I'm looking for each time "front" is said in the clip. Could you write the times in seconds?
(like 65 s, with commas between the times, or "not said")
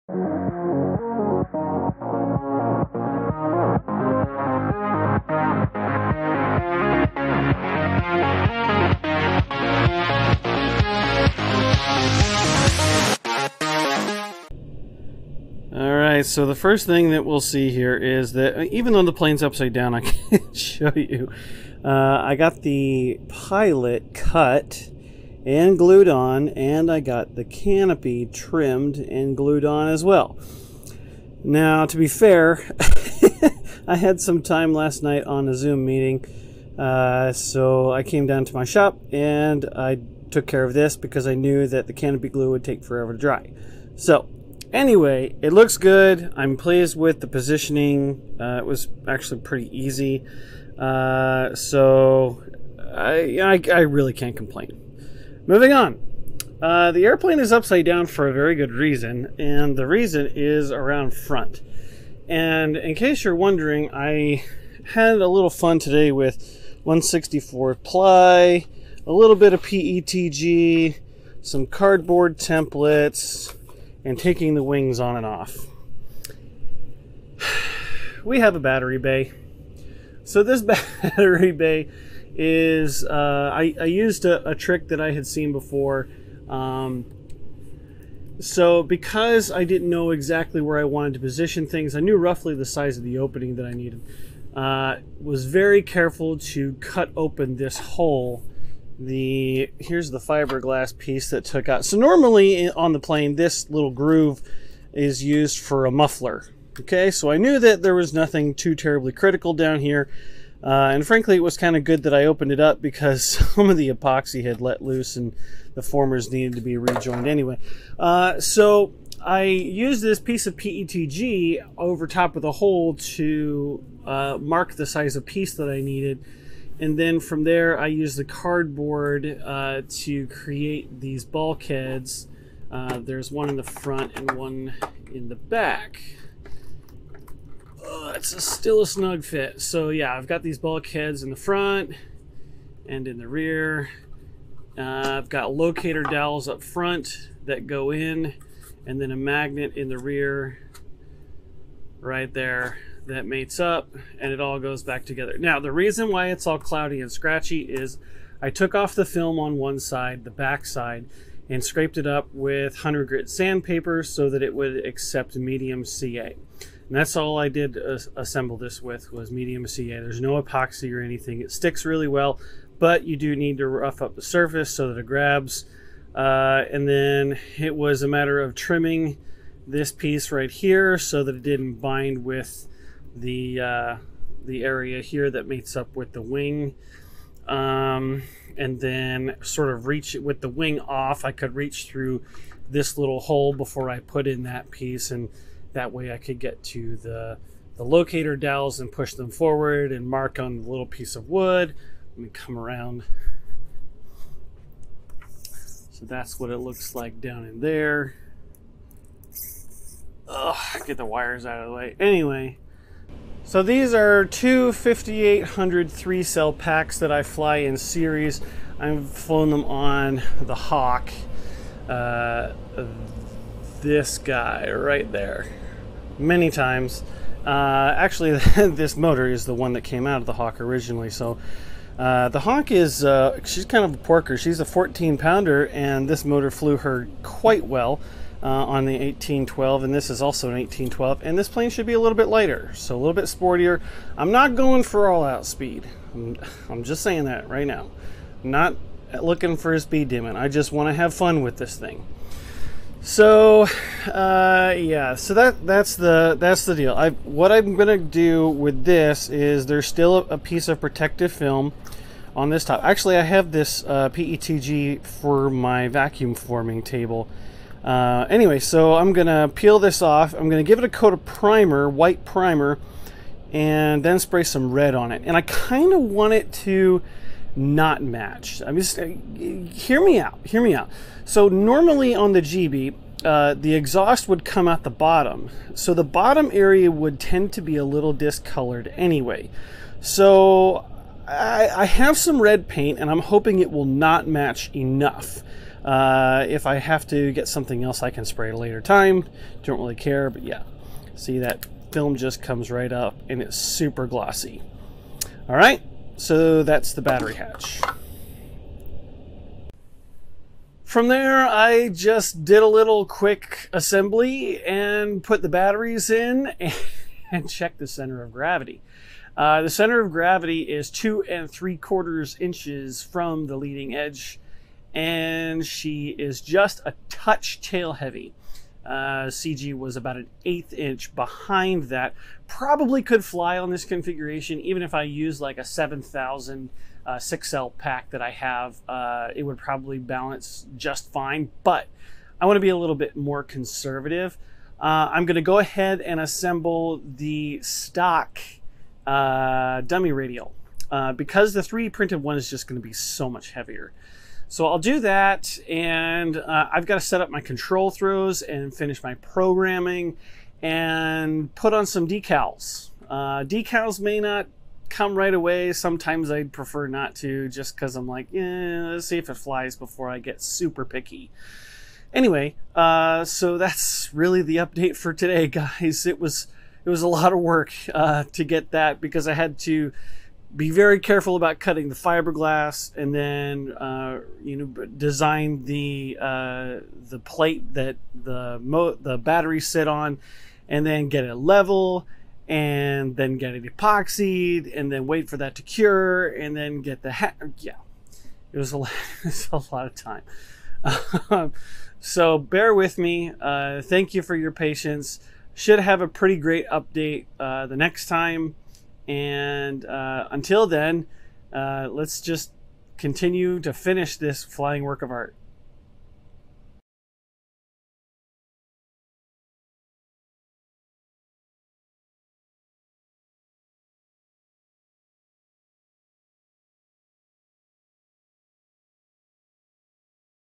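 61 s, 133 s, 141 s, 146 s.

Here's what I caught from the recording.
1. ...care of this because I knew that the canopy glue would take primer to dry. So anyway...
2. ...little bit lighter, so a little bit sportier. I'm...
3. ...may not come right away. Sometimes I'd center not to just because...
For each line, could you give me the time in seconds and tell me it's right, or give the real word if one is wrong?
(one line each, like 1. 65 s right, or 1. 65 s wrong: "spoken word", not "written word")
1. 40 s wrong: "forever", not "primer"
2. 241 s right
3. 364 s wrong: "prefer", not "center".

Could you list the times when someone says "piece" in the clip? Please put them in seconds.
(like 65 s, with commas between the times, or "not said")
100 s, 120 s, 125 s, 179 s, 194 s, 200 s, 260 s.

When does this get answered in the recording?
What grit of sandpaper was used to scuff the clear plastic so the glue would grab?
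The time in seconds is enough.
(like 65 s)
162 s.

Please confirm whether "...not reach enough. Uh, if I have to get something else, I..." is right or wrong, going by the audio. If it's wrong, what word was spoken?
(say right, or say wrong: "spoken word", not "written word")
wrong: "match", not "reach".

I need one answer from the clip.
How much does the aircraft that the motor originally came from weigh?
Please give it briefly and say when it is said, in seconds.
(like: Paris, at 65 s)
14 pounds, at 234 s.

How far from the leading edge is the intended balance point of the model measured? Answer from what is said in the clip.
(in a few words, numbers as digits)
2 3/4 inches.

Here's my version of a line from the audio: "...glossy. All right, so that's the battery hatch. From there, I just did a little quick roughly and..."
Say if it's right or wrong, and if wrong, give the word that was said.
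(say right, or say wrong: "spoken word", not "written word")
wrong: "assembly", not "roughly".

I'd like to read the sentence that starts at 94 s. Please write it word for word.
Uh, was very careful to cut open this hole.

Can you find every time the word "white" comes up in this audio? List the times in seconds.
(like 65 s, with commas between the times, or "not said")
271 s.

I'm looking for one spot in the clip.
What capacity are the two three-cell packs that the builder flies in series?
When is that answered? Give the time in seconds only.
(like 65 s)
214 s.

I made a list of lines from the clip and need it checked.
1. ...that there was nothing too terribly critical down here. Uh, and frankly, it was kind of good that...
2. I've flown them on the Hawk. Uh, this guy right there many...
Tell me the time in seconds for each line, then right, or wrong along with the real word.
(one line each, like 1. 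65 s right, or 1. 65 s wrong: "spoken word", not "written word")
1. 107 s right
2. 218 s right.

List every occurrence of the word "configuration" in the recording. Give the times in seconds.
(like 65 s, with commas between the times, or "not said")
333 s.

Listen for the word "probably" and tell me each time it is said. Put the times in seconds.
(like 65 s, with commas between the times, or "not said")
332 s, 339 s.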